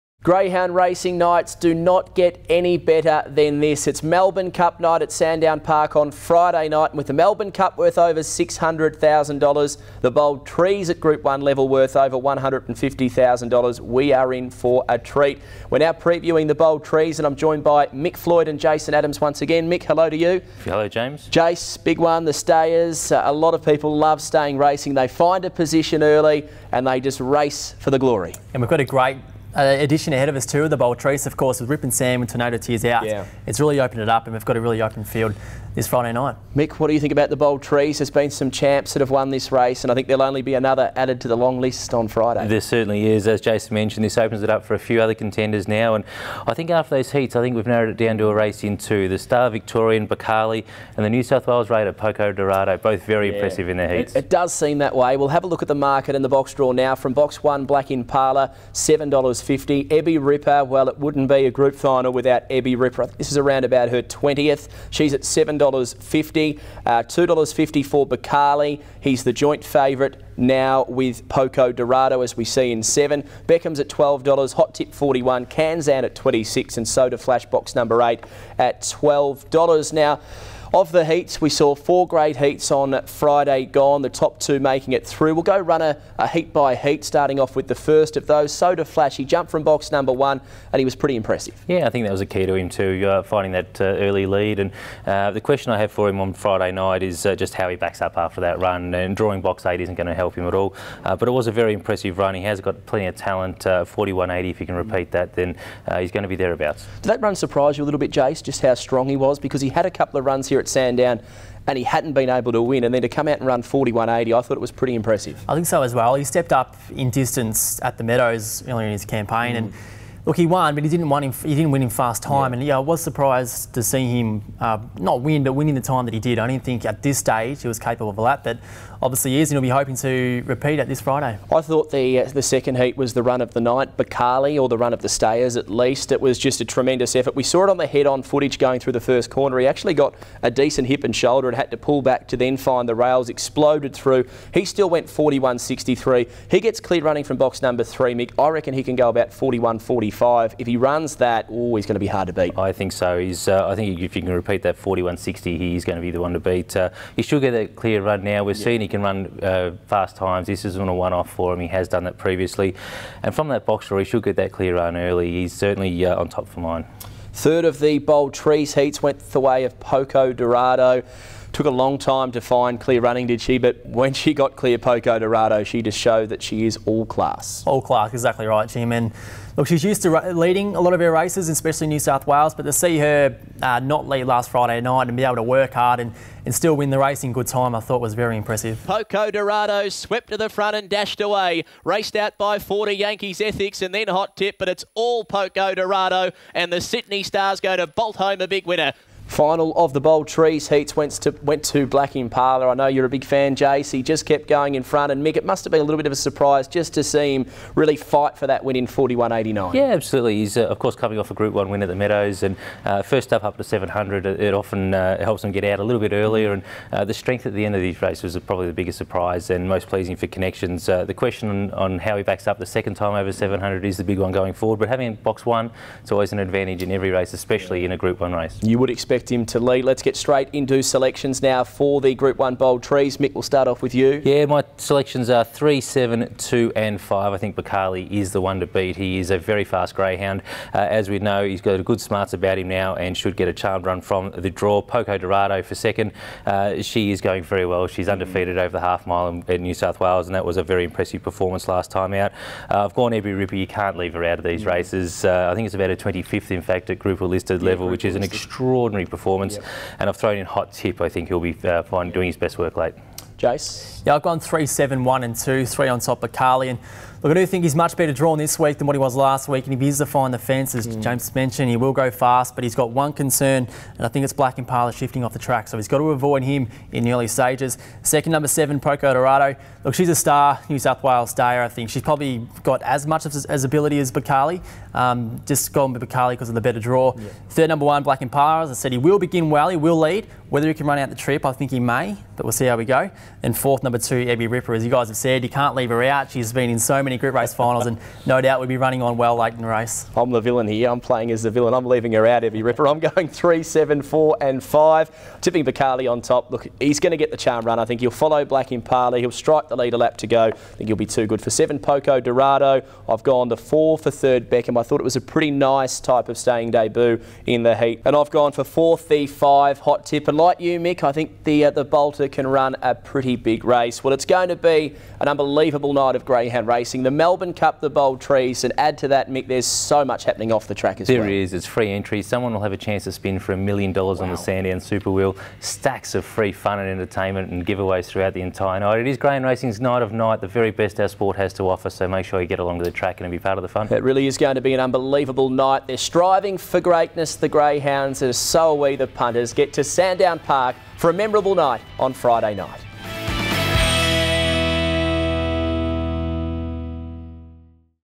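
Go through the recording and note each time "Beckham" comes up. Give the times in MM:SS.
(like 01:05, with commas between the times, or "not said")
01:13, 05:14.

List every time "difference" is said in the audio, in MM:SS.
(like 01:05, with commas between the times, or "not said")
not said.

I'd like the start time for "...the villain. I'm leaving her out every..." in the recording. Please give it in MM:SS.
05:01.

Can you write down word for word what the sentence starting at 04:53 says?
And fourth number two, Ebby Ripper.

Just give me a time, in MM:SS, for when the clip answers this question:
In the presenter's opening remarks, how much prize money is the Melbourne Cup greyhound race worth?
00:07.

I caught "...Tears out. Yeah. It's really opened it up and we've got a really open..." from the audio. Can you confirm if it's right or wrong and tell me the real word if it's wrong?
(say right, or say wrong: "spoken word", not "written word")
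right.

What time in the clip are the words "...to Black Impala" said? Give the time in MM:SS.
03:21.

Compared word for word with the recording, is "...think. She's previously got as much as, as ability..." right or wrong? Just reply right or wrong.
wrong.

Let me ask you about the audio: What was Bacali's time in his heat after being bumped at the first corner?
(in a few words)
41.63.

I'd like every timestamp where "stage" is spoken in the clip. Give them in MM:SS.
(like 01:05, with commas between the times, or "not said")
02:07, 04:37.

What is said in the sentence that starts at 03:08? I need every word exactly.
Poco Dorado swept to the front and dashed away.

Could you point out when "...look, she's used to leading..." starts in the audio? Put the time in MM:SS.
02:59.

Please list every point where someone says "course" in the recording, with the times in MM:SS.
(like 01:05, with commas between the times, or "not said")
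00:31, 03:30.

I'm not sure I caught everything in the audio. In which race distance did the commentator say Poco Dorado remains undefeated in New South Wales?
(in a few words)
half mile.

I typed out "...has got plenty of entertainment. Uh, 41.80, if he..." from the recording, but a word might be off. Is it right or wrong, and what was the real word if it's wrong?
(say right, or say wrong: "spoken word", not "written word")
wrong: "talent", not "entertainment".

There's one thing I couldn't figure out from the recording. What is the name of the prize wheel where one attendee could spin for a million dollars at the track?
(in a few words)
Sandown Super Wheel.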